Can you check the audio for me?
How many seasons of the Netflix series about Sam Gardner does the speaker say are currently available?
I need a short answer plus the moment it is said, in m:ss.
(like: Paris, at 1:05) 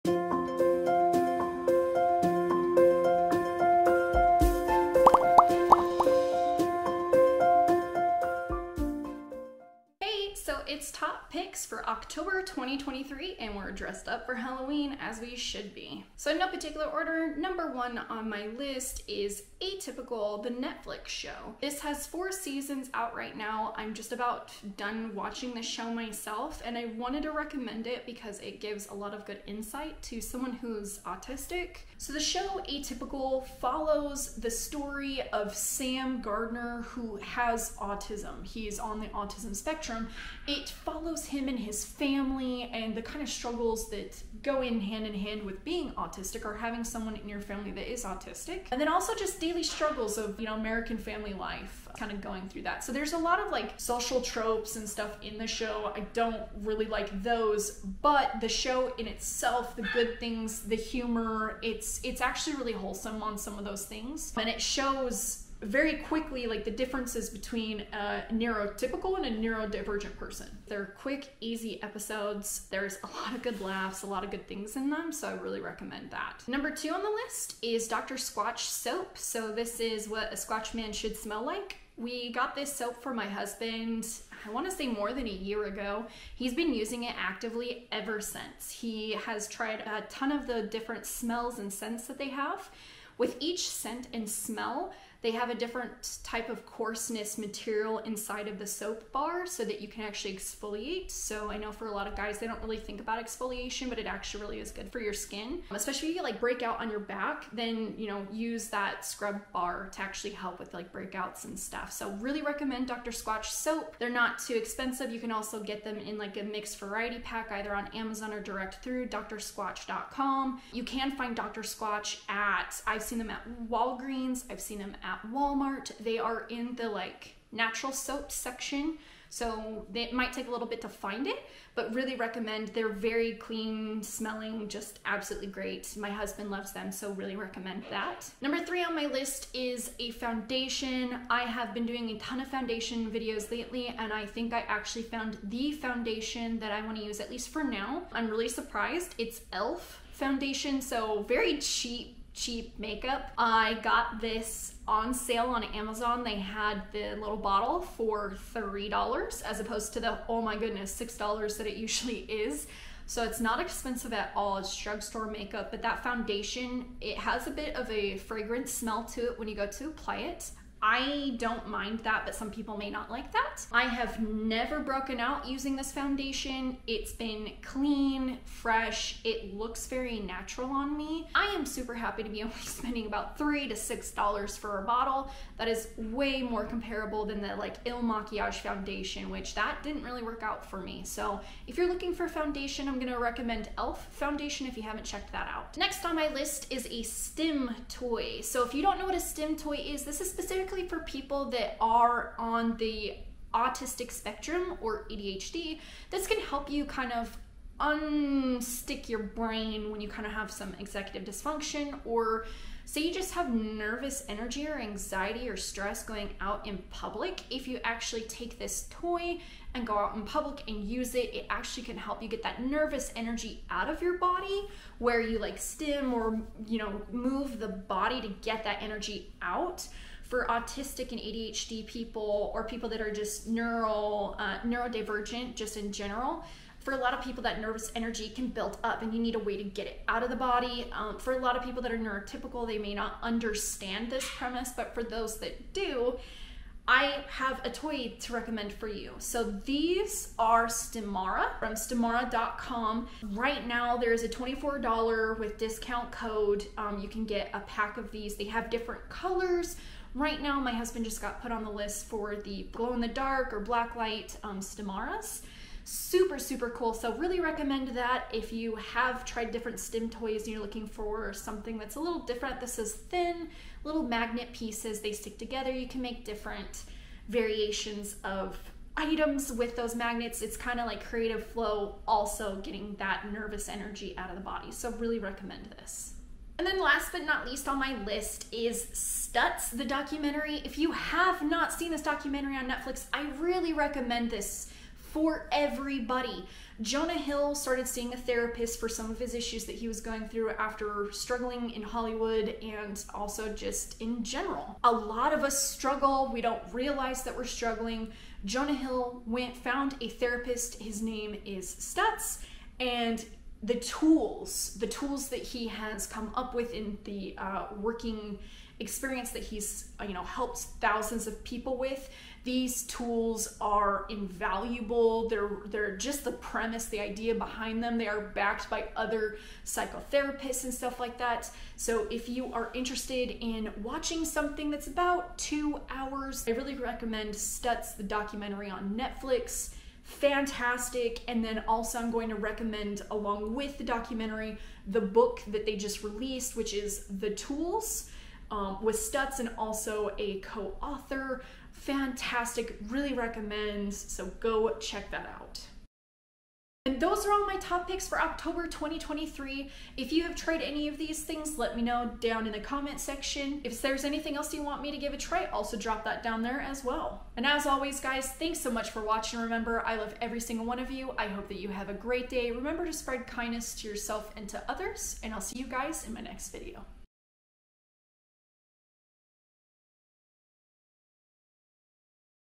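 4, at 0:22.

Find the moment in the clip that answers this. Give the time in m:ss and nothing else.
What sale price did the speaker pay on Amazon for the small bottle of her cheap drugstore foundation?
2:38.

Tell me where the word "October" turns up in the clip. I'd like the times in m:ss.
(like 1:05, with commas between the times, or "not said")
0:11, 5:58.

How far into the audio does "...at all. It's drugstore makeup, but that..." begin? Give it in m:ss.
2:44.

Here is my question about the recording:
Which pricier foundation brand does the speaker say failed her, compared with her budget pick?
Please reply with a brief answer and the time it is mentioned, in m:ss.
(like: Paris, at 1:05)
Il Makiage, at 3:07.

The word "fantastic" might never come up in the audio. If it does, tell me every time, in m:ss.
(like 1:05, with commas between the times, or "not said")
5:40, 5:51.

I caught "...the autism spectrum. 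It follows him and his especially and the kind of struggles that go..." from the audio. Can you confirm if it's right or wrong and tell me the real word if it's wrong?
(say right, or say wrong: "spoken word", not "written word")
wrong: "family", not "especially".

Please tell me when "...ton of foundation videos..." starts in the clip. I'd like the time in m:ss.
2:22.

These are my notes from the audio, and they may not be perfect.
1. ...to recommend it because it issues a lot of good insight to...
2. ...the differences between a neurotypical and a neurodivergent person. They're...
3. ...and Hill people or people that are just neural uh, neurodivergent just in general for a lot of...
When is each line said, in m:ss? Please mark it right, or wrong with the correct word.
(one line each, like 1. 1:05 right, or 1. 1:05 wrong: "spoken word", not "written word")
1. 0:27 wrong: "gives", not "issues"
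2. 1:06 right
3. 3:51 wrong: "ADHD", not "Hill".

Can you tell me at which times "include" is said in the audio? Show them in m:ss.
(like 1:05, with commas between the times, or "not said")
not said.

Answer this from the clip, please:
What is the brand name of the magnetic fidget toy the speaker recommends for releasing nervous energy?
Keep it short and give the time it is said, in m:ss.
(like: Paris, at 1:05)
Stimara, at 4:10.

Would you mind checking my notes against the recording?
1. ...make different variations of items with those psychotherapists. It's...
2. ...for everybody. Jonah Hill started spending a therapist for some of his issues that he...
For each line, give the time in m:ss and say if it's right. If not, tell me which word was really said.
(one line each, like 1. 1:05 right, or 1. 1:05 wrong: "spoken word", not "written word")
1. 4:36 wrong: "magnets", not "psychotherapists"
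2. 4:55 wrong: "seeing", not "spending".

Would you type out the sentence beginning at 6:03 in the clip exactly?
If there's anything else you want me to give a try, also drop that down there as well.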